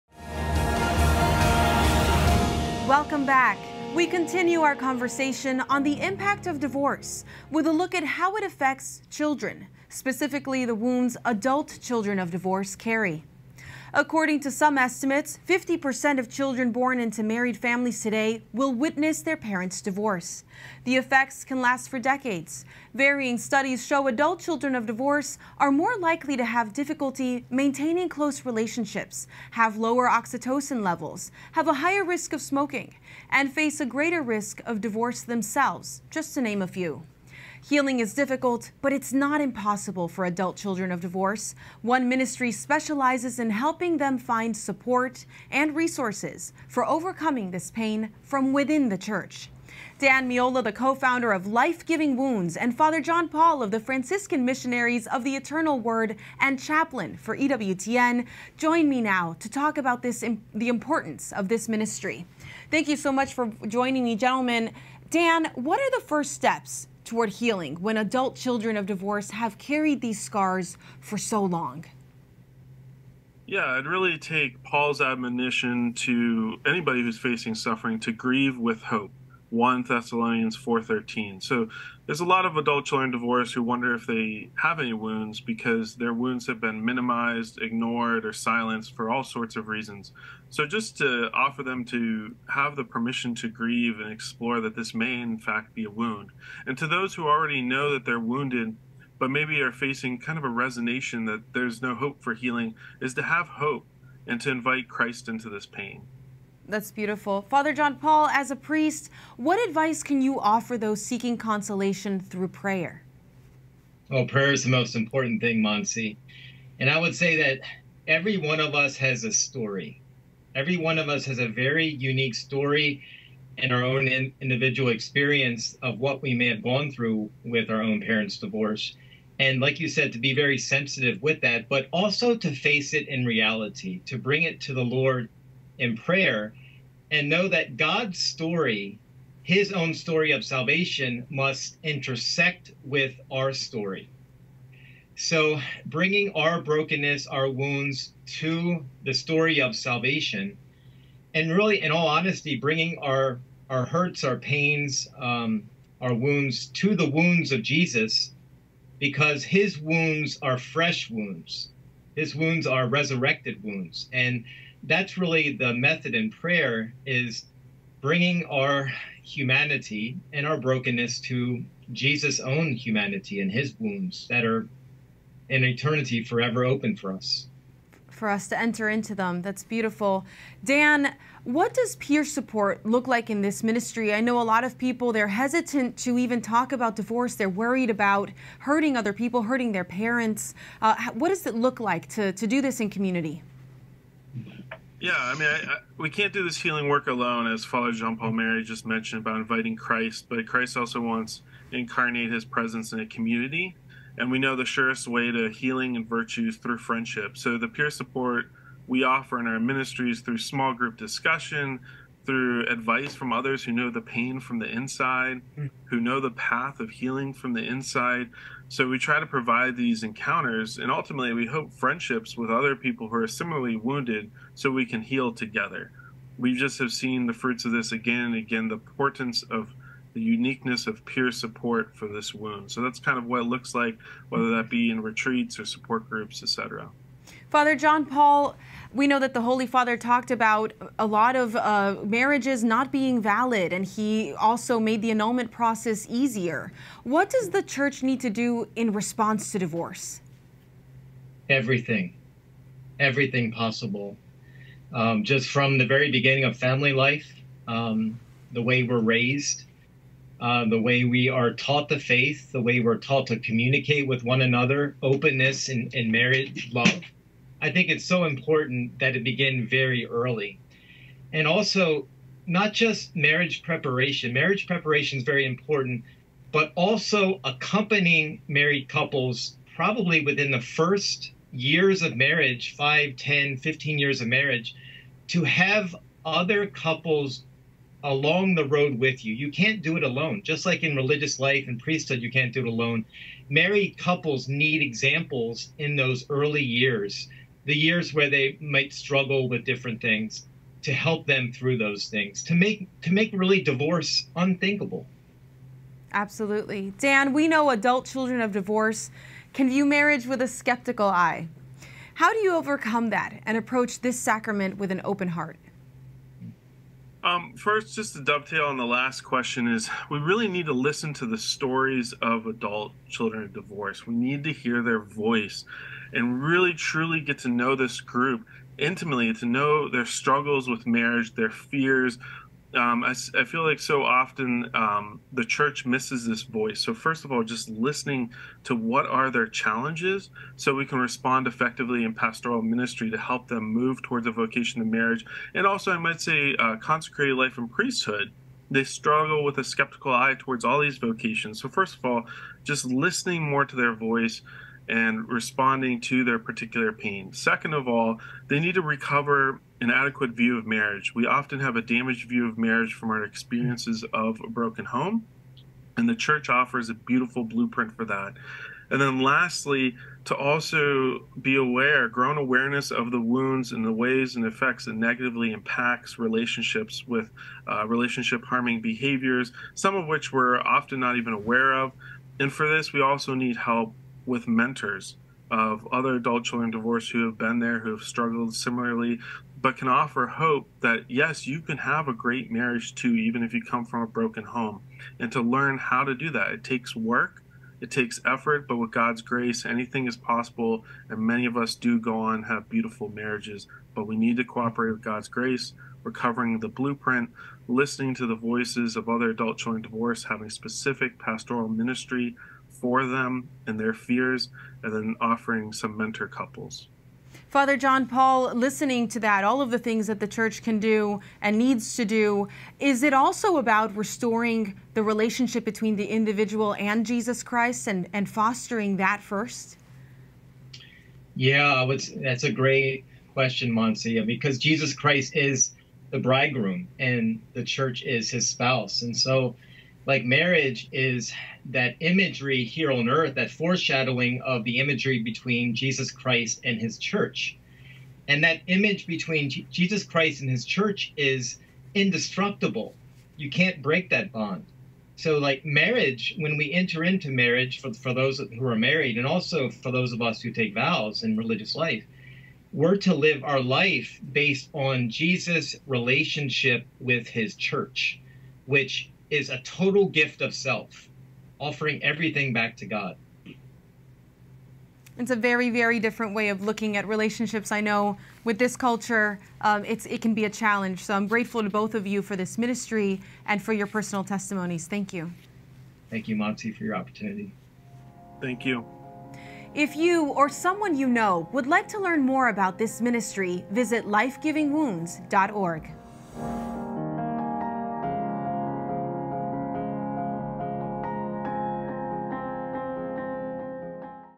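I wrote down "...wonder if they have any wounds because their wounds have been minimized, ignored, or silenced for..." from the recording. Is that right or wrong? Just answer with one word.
right.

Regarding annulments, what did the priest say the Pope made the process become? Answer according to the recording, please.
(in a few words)
easier.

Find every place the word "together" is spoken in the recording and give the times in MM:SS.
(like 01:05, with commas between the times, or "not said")
03:45.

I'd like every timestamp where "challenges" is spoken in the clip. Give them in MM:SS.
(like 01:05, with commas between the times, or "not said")
05:39, 08:00.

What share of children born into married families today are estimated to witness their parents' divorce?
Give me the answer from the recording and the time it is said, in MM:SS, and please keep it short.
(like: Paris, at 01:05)
50%, at 00:15.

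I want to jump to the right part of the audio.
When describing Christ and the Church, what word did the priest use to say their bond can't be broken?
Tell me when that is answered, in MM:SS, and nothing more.
07:31.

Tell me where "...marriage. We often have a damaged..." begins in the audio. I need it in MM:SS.
06:00.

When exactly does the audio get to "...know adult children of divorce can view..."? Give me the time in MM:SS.
05:07.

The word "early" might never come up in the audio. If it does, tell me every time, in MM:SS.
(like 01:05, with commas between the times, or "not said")
04:30, 04:56.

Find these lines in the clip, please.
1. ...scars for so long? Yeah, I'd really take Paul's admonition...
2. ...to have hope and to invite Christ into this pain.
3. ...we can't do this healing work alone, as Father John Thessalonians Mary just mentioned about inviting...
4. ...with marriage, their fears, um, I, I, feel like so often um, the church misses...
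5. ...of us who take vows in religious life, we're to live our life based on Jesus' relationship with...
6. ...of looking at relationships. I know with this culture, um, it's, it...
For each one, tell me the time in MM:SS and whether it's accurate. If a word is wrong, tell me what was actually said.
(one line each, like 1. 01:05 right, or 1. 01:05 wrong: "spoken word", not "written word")
1. 01:10 right
2. 01:43 right
3. 03:15 wrong: "Paul", not "Thessalonians"
4. 05:30 right
5. 07:40 right
6. 07:56 right.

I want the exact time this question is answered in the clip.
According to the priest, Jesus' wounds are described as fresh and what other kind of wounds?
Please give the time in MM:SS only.
02:42.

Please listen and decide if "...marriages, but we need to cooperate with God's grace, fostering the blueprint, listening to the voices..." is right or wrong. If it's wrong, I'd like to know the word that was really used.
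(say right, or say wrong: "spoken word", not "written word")
wrong: "recovering", not "fostering".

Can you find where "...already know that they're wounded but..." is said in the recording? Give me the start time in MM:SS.
01:37.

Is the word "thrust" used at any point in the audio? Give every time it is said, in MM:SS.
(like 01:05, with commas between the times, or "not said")
not said.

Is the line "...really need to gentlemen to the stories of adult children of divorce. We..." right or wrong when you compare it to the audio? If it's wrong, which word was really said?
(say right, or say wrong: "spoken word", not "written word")
wrong: "listen", not "gentlemen".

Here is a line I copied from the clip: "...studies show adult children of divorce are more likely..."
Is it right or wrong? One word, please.
right.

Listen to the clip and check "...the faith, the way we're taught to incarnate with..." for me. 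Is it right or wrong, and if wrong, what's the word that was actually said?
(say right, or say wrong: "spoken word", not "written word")
wrong: "communicate", not "incarnate".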